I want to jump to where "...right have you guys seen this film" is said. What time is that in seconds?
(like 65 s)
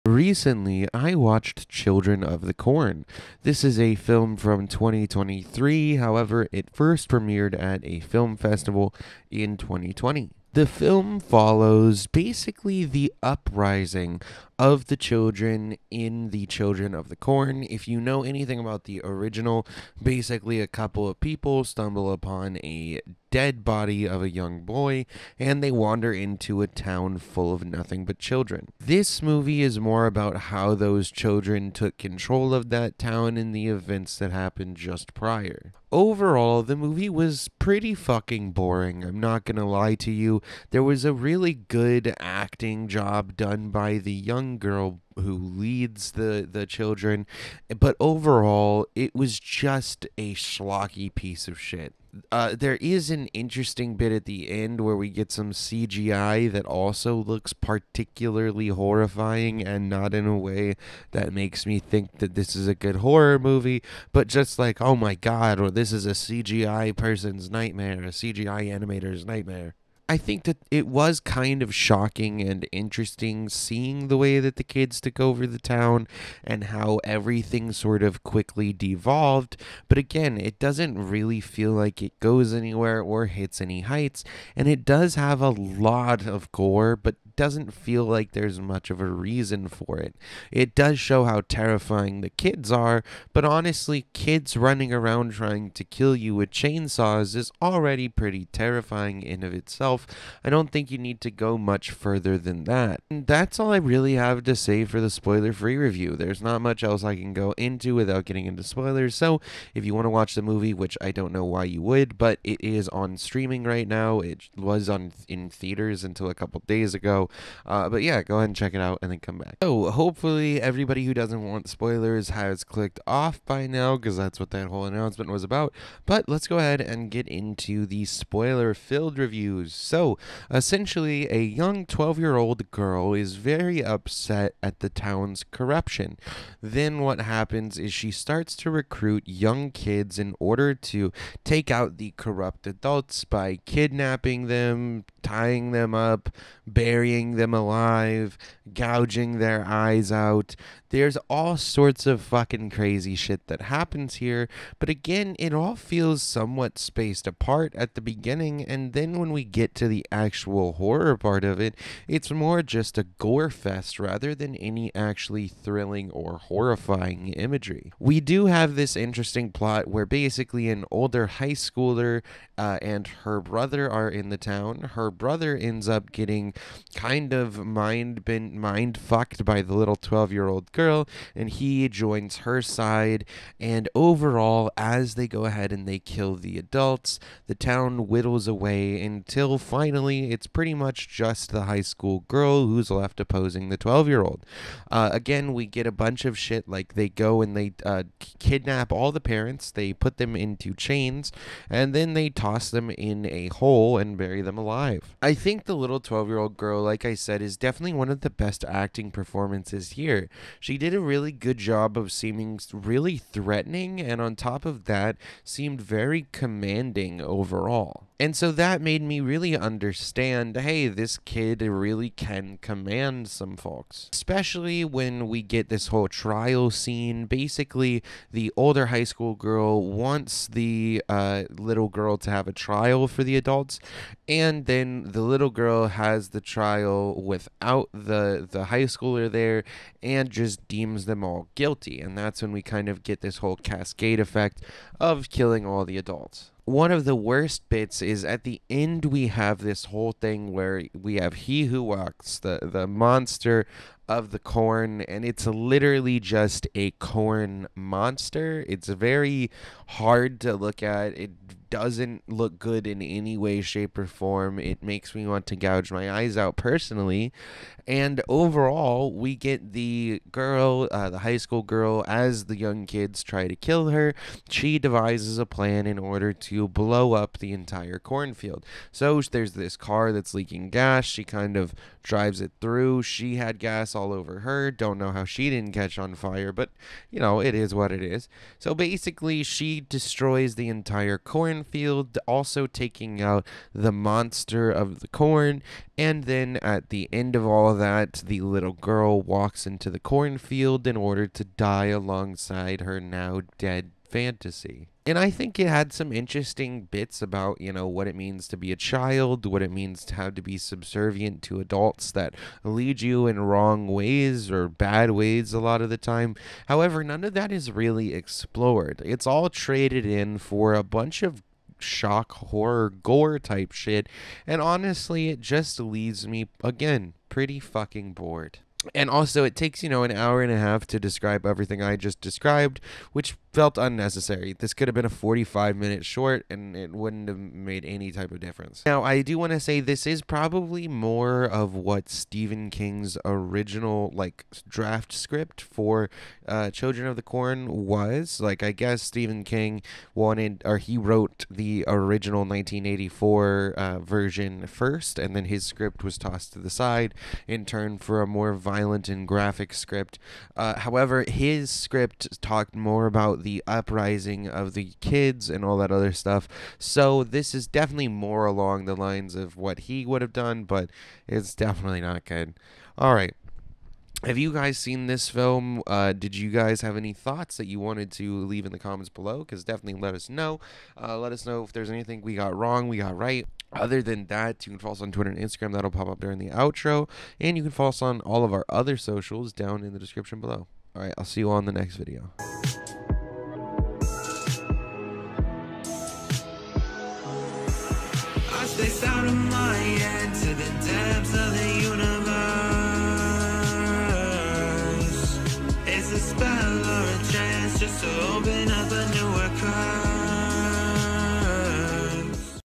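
373 s.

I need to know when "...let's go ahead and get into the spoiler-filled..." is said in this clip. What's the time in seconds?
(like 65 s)
126 s.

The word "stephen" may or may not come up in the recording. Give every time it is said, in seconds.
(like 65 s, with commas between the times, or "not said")
342 s, 349 s.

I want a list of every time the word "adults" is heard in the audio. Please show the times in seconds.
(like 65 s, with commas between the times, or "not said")
142 s, 186 s, 233 s, 245 s, 311 s.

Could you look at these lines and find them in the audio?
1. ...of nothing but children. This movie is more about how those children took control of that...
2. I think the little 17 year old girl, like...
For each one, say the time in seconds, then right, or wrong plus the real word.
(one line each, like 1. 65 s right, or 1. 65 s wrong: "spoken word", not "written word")
1. 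27 s right
2. 205 s wrong: "12", not "17".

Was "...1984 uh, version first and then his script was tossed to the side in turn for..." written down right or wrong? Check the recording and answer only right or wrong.
right.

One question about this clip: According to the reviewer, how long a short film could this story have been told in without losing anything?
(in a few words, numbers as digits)
45 minutes.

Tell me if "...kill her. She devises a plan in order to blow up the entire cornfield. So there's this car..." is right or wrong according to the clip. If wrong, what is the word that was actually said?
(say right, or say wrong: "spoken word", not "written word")
right.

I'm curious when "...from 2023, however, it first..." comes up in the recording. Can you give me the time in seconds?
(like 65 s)
4 s.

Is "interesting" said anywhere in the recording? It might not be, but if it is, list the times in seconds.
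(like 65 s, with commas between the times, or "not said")
53 s, 72 s, 168 s, 306 s.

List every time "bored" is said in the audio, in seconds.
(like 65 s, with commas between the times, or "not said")
328 s.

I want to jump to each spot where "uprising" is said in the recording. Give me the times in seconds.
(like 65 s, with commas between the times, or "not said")
13 s, 363 s.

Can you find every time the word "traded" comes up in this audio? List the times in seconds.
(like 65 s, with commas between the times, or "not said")
319 s.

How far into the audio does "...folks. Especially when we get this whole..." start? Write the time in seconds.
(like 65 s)
223 s.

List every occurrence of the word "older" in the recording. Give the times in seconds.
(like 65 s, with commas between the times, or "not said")
170 s, 228 s.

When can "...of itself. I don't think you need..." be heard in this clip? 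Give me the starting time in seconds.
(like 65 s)
99 s.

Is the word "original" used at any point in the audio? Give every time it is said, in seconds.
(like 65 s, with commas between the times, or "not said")
19 s, 343 s, 351 s.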